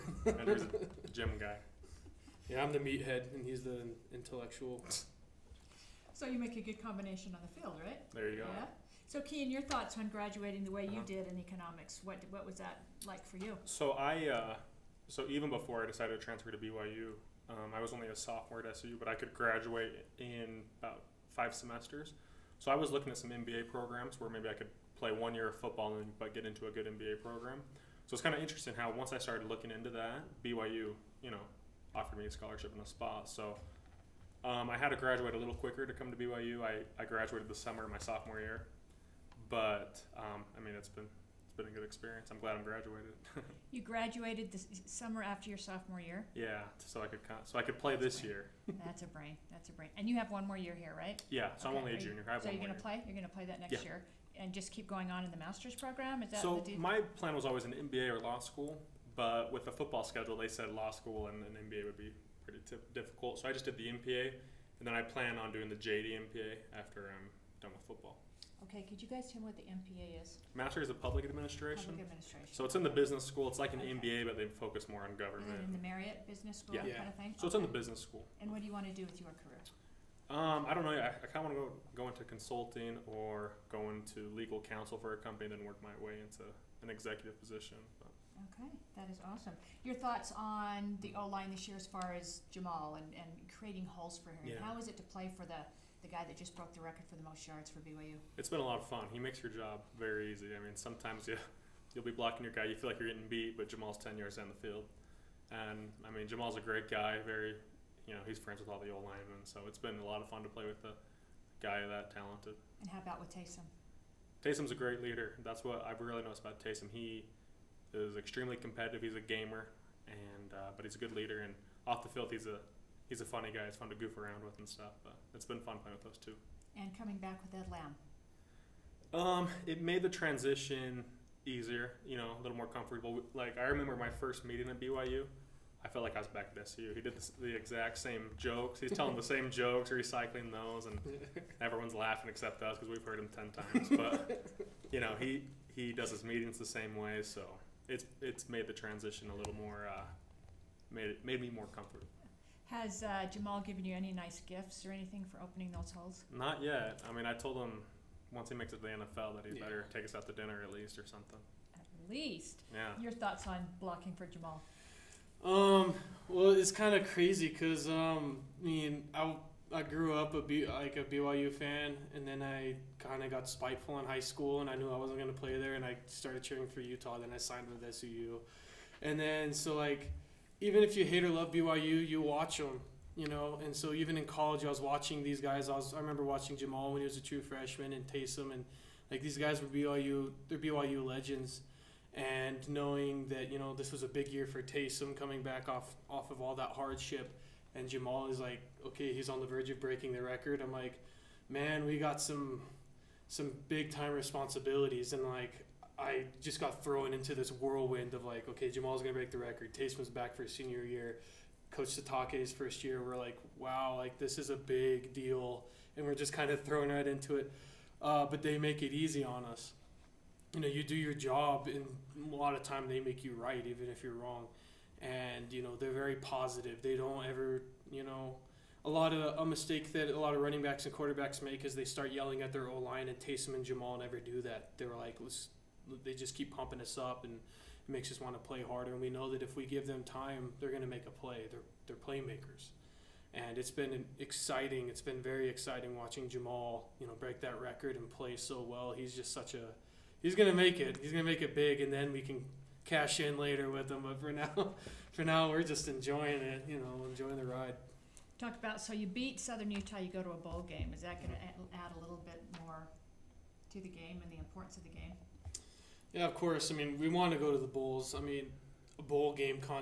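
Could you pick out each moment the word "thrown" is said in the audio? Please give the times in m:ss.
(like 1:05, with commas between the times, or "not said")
3:26, 3:36.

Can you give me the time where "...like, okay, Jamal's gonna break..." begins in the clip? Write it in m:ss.
3:28.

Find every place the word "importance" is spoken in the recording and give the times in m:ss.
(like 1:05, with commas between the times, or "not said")
4:24.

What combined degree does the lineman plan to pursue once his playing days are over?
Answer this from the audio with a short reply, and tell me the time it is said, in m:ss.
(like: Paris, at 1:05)
JD MPA, at 1:05.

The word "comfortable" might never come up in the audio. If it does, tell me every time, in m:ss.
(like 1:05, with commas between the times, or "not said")
2:12, 2:31.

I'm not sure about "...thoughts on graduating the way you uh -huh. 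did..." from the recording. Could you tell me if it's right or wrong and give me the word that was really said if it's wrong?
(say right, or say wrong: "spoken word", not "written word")
right.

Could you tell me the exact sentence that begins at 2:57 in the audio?
Then I signed with SUU, and then so like even if you hate or love BYU, you watch them, you know.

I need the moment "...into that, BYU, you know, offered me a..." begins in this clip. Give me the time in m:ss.
0:29.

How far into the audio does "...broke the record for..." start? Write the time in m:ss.
1:36.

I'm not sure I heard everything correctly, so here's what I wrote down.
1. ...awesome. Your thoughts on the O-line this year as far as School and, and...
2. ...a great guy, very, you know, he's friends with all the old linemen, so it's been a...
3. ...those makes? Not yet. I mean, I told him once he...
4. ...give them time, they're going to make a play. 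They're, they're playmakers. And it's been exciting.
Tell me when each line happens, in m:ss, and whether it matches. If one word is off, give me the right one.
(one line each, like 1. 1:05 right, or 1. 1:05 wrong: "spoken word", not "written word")
1. 1:29 wrong: "Jamal", not "School"
2. 1:46 right
3. 2:35 wrong: "holes", not "makes"
4. 3:59 right.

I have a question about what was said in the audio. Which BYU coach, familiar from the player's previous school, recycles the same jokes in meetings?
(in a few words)
Ed Lamb.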